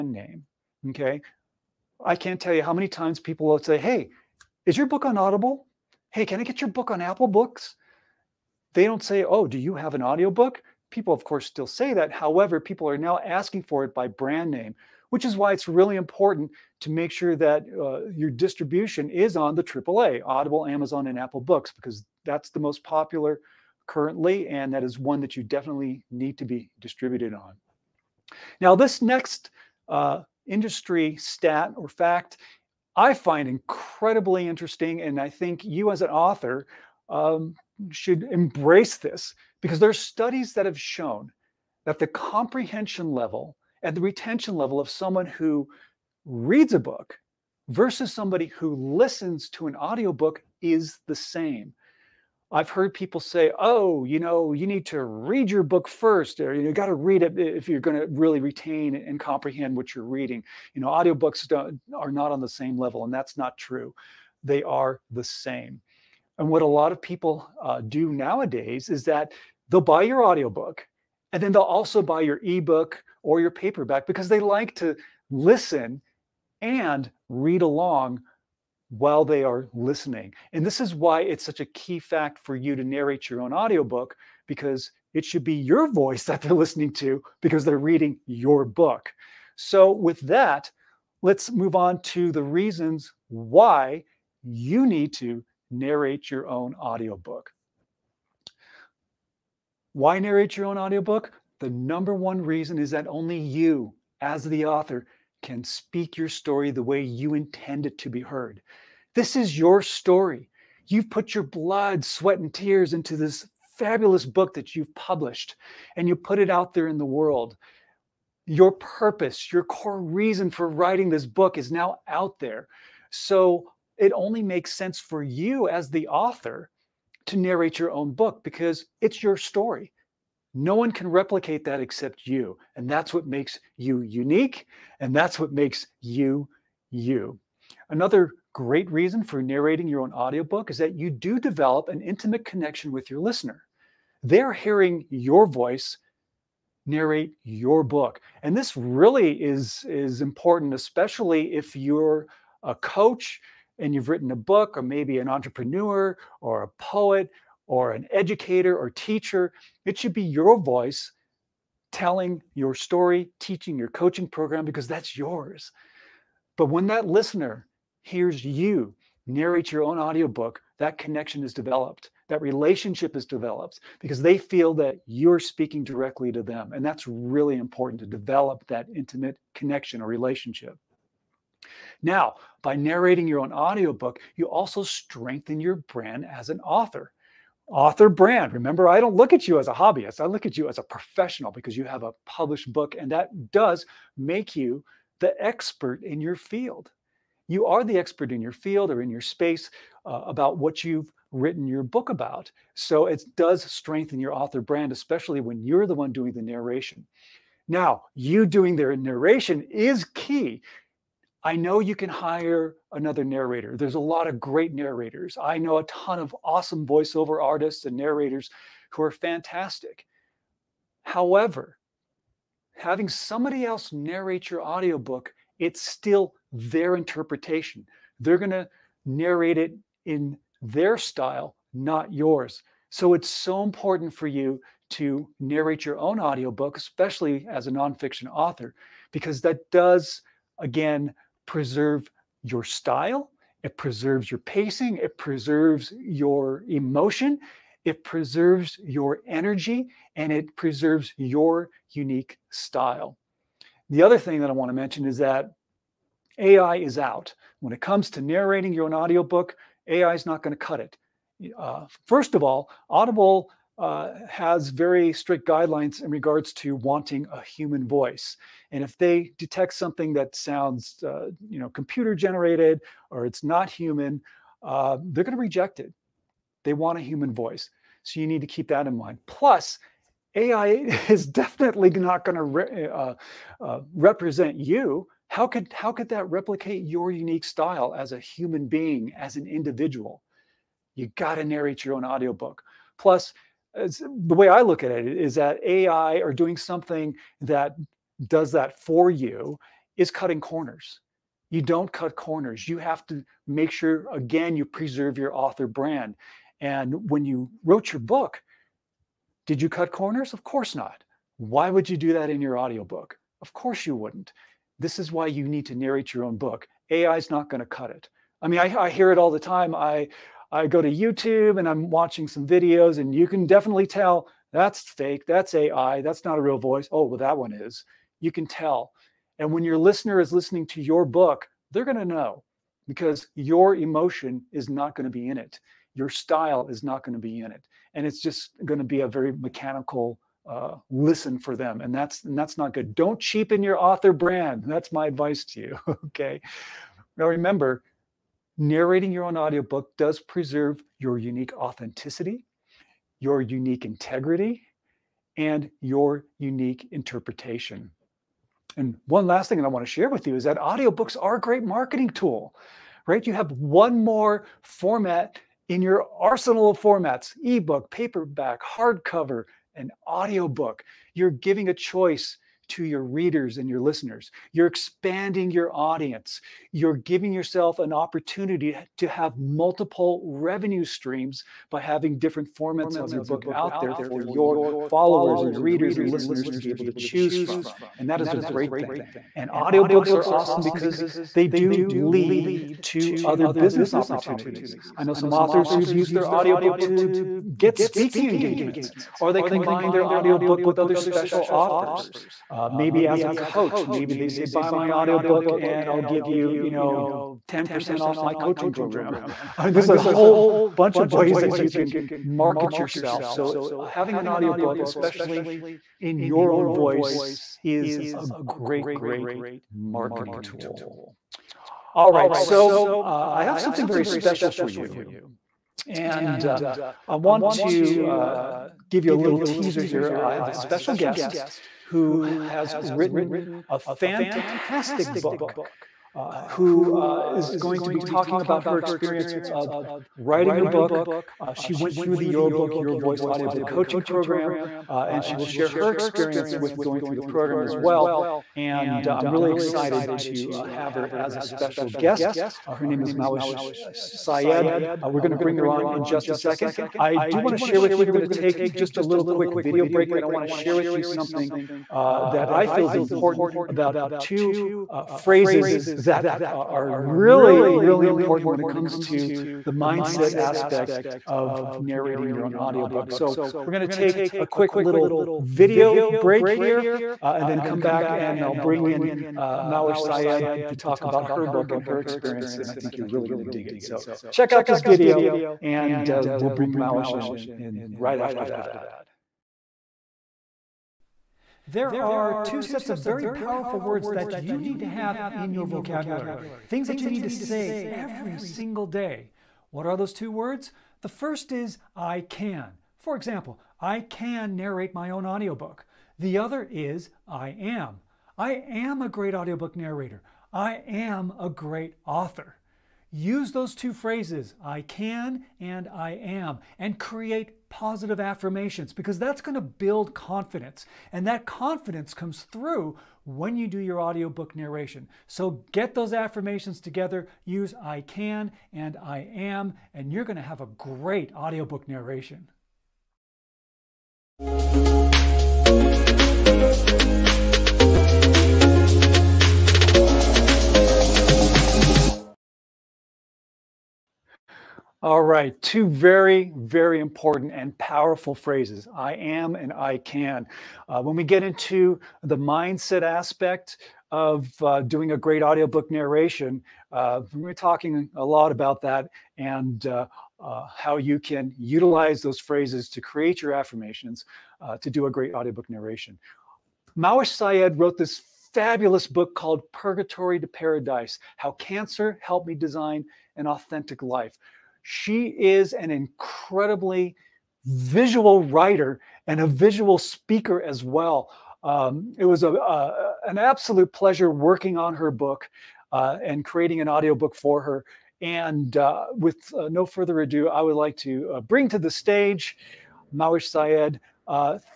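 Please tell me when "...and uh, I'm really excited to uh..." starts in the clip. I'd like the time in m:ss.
7:28.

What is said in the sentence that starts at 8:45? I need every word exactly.
So get those affirmations together, use I can and I am, and you're going to have a great audiobook narration.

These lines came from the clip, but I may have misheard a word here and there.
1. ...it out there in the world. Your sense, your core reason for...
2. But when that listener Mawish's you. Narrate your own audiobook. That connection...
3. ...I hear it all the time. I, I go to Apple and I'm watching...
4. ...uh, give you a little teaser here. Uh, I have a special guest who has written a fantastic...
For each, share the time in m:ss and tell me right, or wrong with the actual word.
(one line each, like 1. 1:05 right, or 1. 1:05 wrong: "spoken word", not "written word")
1. 1:56 wrong: "purpose", not "sense"
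2. 2:46 wrong: "Here", not "Mawish"
3. 5:18 wrong: "YouTube", not "Apple"
4. 7:08 right.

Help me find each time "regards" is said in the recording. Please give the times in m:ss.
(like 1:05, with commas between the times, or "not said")
4:26.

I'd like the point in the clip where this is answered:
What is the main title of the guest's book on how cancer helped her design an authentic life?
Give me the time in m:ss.
9:29.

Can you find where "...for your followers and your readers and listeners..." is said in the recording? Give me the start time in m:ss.
6:23.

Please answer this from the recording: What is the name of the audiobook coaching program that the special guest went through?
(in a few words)
Your Book, Your Voice.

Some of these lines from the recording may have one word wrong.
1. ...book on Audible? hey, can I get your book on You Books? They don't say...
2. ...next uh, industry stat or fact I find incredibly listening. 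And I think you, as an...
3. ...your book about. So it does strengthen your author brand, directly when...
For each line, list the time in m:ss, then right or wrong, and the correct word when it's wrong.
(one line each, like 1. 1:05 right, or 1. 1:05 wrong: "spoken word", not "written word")
1. 0:04 wrong: "Apple", not "You"
2. 0:29 wrong: "interesting", not "listening"
3. 3:21 wrong: "especially", not "directly".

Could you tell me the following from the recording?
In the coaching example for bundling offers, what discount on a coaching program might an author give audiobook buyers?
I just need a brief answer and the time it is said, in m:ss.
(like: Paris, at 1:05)
10%, at 6:47.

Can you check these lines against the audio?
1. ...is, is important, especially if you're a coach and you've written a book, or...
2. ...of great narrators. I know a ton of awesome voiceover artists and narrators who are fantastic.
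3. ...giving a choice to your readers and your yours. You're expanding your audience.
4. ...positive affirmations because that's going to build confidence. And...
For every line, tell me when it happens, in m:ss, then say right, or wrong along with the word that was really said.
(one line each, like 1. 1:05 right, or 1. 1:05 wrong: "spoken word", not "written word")
1. 2:29 right
2. 3:34 right
3. 6:11 wrong: "listeners", not "yours"
4. 8:37 right.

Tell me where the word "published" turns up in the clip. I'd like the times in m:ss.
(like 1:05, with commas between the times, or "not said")
1:54, 3:12.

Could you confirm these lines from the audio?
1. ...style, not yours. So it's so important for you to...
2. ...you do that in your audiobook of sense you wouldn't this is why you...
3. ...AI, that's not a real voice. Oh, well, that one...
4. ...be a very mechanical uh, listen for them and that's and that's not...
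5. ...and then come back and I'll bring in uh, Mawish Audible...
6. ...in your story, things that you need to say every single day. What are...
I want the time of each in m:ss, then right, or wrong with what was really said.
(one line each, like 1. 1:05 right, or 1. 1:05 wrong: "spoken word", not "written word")
1. 3:50 right
2. 5:11 wrong: "course", not "sense"
3. 5:25 right
4. 5:38 right
5. 7:57 wrong: "Syed", not "Audible"
6. 8:15 wrong: "vocabulary", not "story".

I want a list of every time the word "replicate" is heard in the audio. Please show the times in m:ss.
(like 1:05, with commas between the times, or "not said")
2:11, 4:46.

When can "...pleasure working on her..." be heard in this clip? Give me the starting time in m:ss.
9:43.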